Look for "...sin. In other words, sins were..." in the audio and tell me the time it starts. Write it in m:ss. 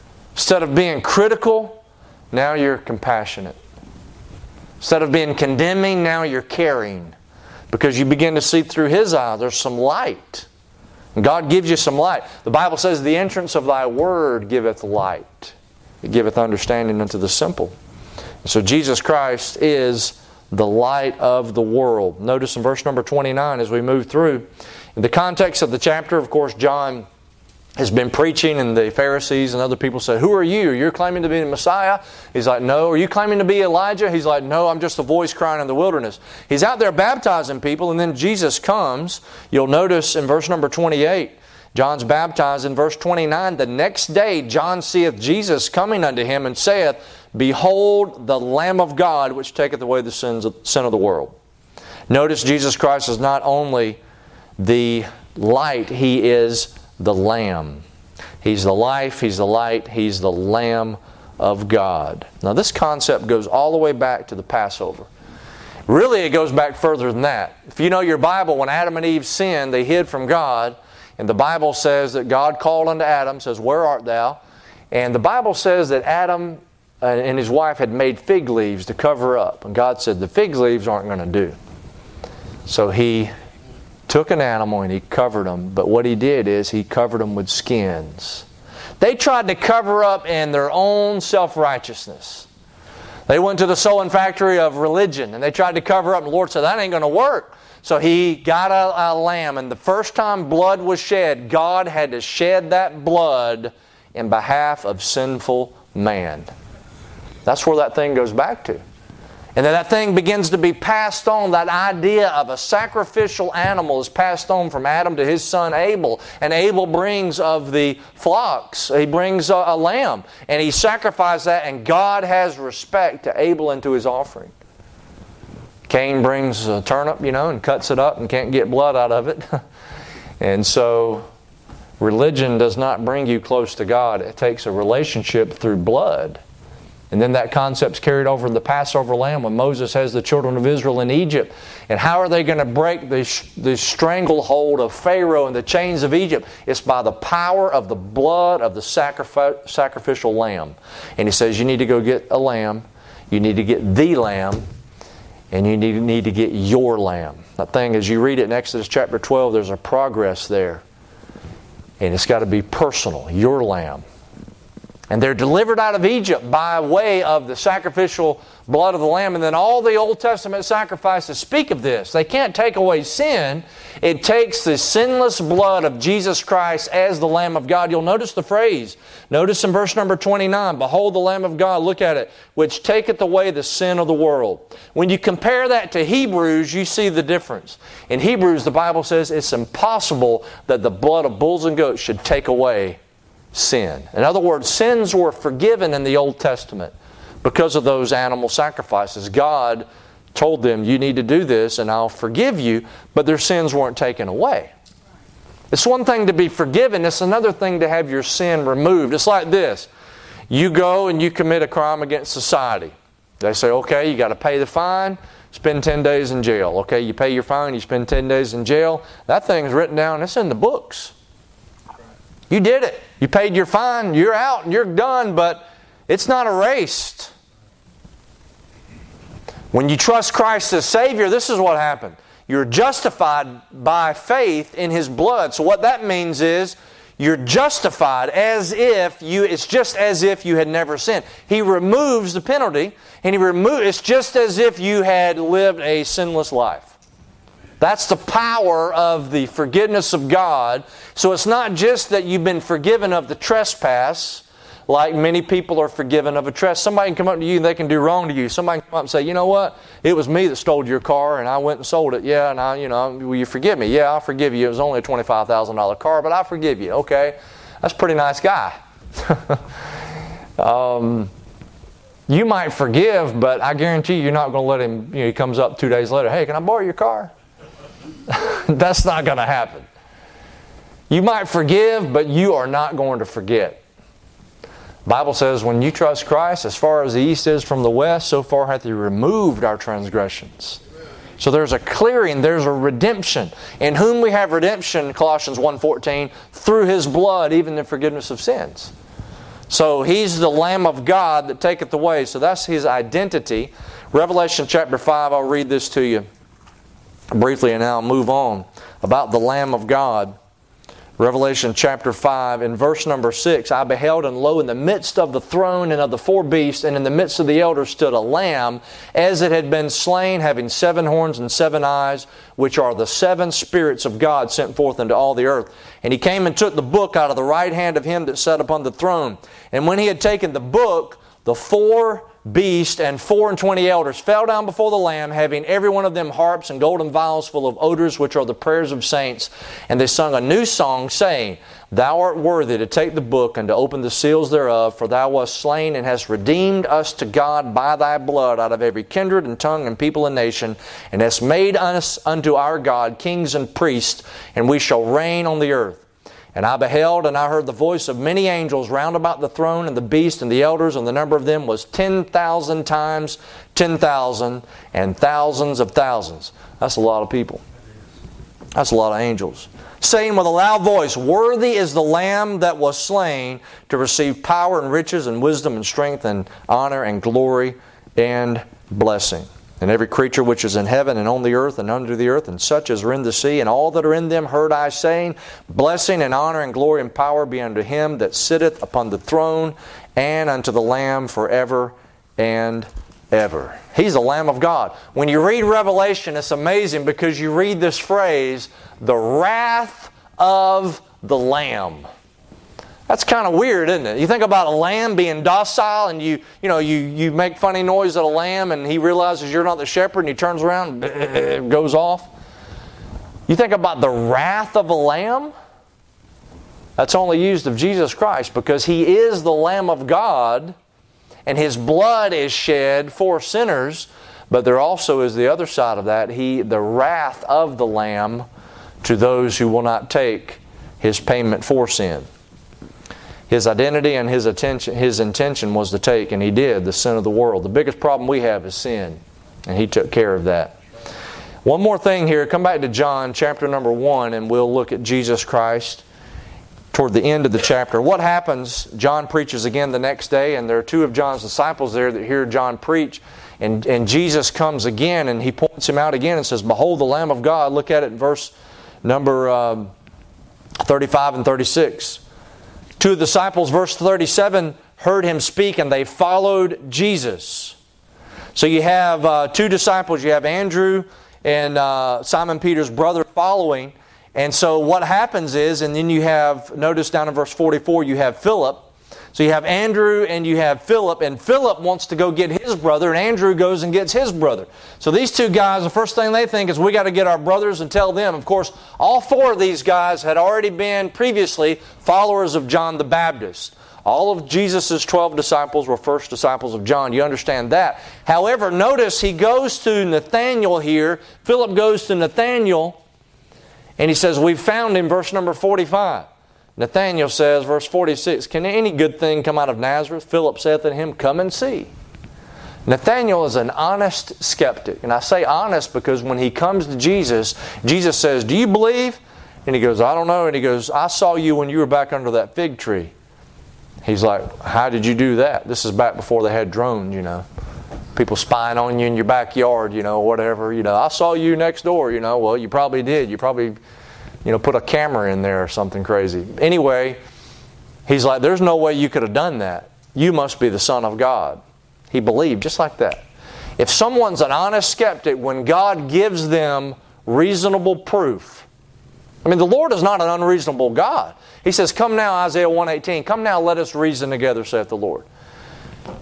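3:13.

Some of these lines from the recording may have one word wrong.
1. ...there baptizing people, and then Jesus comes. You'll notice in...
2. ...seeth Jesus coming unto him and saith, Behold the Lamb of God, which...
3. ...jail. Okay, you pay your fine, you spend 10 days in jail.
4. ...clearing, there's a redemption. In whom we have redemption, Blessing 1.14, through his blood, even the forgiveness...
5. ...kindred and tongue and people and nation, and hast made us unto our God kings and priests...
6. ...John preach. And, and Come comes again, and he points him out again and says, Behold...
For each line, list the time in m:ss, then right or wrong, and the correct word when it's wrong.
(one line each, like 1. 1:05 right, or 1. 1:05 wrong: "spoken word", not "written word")
1. 0:36 right
2. 0:44 right
3. 3:36 right
4. 4:51 wrong: "Colossians", not "Blessing"
5. 5:49 right
6. 7:32 wrong: "Jesus", not "Come".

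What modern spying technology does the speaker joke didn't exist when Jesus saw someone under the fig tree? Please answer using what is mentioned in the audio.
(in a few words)
Drones.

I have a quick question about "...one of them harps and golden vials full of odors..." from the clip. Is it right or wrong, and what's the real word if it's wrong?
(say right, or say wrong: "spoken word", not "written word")
right.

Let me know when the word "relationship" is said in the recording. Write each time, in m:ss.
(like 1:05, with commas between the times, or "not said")
2:14.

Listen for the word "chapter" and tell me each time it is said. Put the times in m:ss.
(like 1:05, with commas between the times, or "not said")
0:25, 2:38, 5:04, 5:11, 7:23, 7:27.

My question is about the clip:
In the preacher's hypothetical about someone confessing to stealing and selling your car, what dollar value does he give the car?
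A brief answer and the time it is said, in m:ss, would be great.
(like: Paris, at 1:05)
$25,000, at 4:25.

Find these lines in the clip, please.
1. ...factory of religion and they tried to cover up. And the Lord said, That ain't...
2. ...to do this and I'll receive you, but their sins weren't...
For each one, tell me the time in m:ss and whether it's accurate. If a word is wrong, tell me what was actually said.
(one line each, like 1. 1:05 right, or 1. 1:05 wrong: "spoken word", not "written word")
1. 1:34 right
2. 3:21 wrong: "forgive", not "receive".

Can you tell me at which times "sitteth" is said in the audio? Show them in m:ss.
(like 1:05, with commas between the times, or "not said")
6:28.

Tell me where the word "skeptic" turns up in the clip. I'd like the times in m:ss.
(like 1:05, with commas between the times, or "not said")
8:34, 9:04.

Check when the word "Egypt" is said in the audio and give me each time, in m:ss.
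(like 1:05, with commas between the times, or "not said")
2:21, 2:26, 2:46.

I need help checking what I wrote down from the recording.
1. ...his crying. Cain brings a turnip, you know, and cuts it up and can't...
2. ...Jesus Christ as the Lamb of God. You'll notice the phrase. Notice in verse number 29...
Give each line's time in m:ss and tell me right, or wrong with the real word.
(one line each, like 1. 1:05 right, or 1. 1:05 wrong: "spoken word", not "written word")
1. 2:03 wrong: "offering", not "crying"
2. 2:55 right.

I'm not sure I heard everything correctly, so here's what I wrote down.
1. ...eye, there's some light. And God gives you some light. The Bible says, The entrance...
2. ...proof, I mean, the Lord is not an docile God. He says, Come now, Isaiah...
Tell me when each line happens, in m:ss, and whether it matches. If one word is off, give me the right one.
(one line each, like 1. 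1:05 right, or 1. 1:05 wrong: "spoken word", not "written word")
1. 0:09 right
2. 9:07 wrong: "unreasonable", not "docile".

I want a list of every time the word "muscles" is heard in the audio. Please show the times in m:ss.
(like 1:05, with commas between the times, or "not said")
not said.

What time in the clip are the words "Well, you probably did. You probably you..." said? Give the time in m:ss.
8:52.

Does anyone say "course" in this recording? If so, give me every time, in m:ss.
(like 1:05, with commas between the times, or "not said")
0:26, 8:08.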